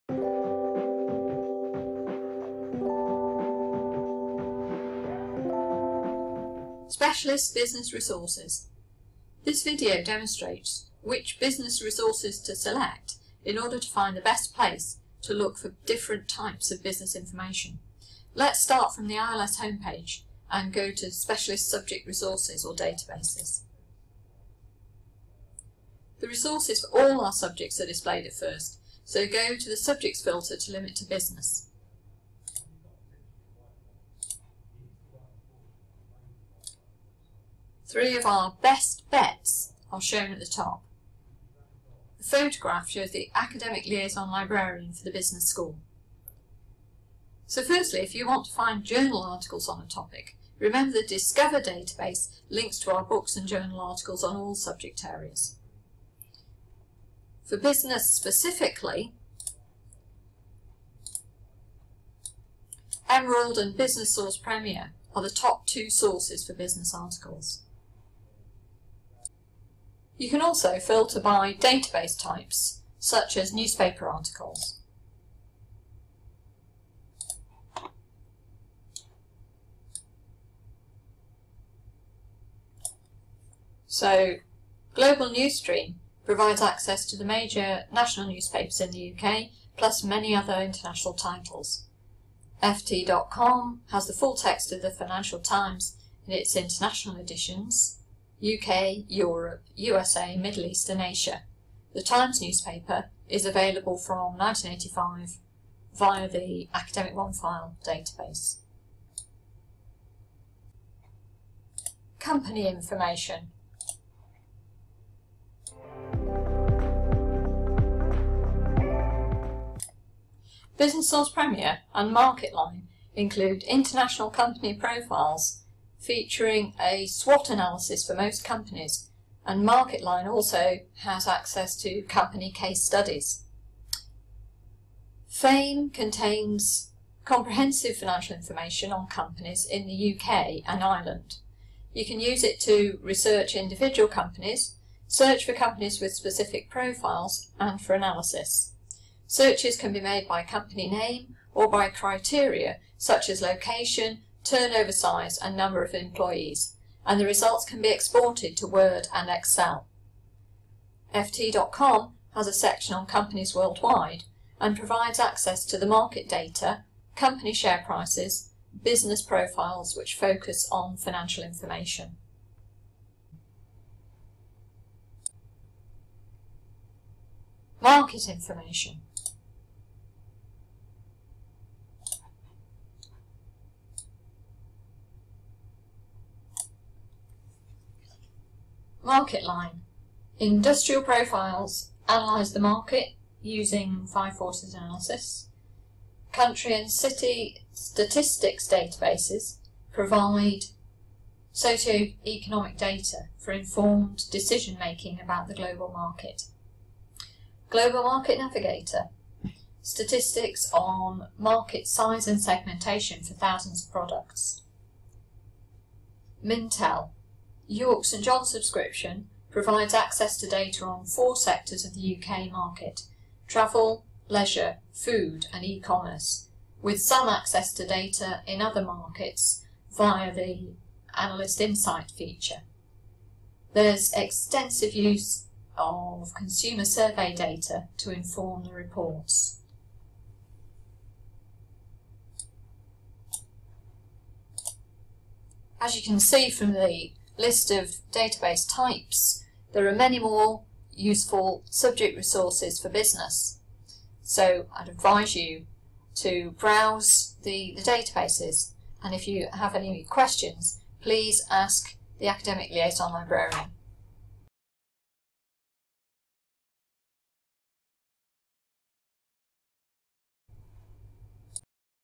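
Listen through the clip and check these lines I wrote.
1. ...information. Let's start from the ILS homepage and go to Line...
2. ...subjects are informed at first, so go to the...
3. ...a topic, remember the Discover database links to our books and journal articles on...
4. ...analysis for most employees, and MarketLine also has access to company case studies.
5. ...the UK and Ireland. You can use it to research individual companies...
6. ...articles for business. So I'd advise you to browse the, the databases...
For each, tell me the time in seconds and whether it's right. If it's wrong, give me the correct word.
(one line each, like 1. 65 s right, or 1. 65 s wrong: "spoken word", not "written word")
1. 17 s wrong: "Specialist", not "Line"
2. 27 s wrong: "displayed", not "informed"
3. 49 s right
4. 127 s wrong: "companies", not "employees"
5. 139 s right
6. 252 s wrong: "resources", not "articles".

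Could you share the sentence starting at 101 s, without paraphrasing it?
The Times newspaper is available from 1985 via the Academic OneFile database.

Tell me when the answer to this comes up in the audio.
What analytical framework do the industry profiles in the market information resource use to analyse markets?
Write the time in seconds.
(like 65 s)
194 s.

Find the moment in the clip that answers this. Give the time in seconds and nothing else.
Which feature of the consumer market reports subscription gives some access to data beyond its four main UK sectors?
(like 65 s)
231 s.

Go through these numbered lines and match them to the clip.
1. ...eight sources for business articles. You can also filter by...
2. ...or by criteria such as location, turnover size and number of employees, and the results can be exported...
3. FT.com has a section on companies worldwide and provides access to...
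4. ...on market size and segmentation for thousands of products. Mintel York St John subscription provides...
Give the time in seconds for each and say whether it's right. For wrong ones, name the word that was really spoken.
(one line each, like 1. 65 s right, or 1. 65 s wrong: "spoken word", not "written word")
1. 65 s wrong: "two", not "eight"
2. 151 s right
3. 161 s right
4. 210 s right.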